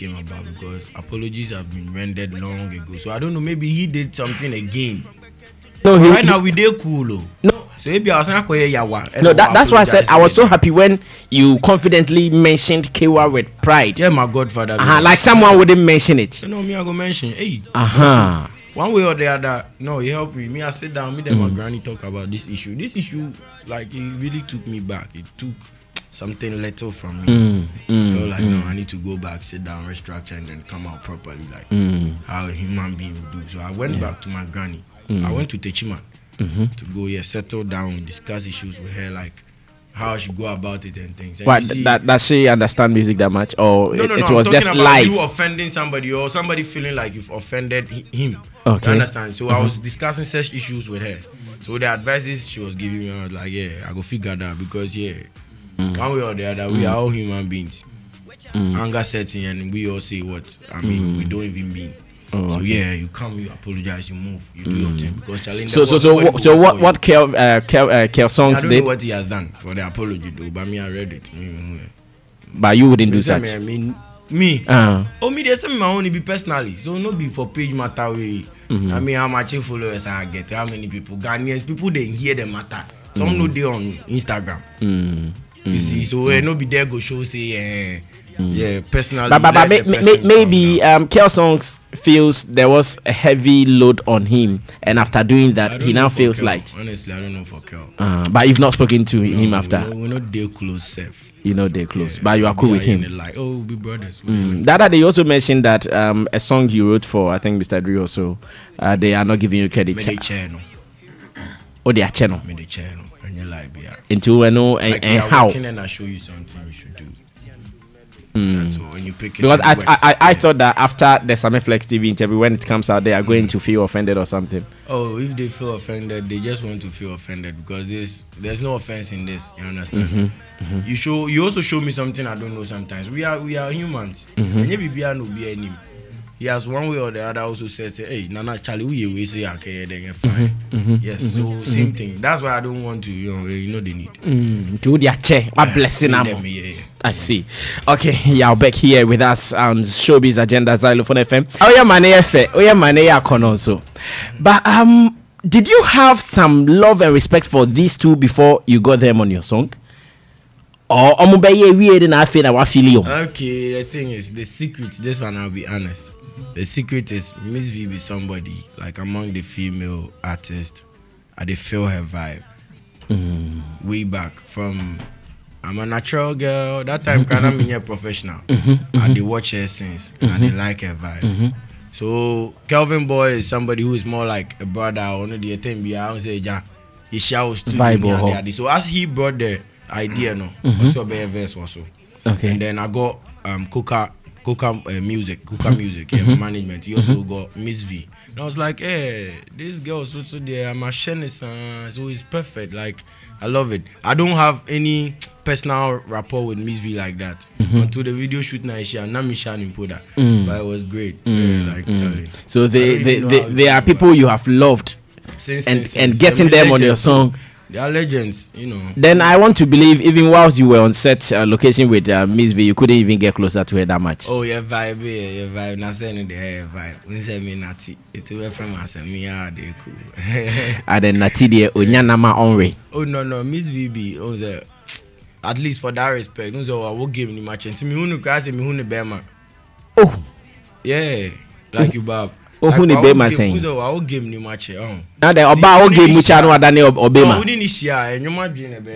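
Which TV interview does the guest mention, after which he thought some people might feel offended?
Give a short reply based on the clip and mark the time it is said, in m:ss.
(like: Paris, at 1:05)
Sammy Flex TV, at 2:01.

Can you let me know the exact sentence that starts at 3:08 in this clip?
So as he brought the idea no, also a verse also.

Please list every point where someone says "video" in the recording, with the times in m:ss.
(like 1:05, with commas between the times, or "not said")
3:28.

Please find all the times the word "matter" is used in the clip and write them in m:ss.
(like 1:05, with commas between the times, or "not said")
1:17, 1:22.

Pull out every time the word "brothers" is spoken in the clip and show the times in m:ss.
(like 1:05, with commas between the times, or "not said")
1:43, 3:04.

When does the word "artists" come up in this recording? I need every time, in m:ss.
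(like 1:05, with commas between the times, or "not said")
2:50.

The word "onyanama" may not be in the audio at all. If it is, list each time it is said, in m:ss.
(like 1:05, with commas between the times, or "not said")
3:51.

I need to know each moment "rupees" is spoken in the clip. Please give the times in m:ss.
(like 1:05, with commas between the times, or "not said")
not said.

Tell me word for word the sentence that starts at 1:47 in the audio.
Dre also, uh, they are not giving you credit.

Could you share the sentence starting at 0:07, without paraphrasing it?
No, so maybe I was not quite yawa.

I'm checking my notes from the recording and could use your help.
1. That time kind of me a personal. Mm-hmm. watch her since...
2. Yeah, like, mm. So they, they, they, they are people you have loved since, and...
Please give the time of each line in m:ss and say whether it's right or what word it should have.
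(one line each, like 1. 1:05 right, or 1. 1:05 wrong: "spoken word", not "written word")
1. 2:56 wrong: "professional", not "personal"
2. 3:31 right.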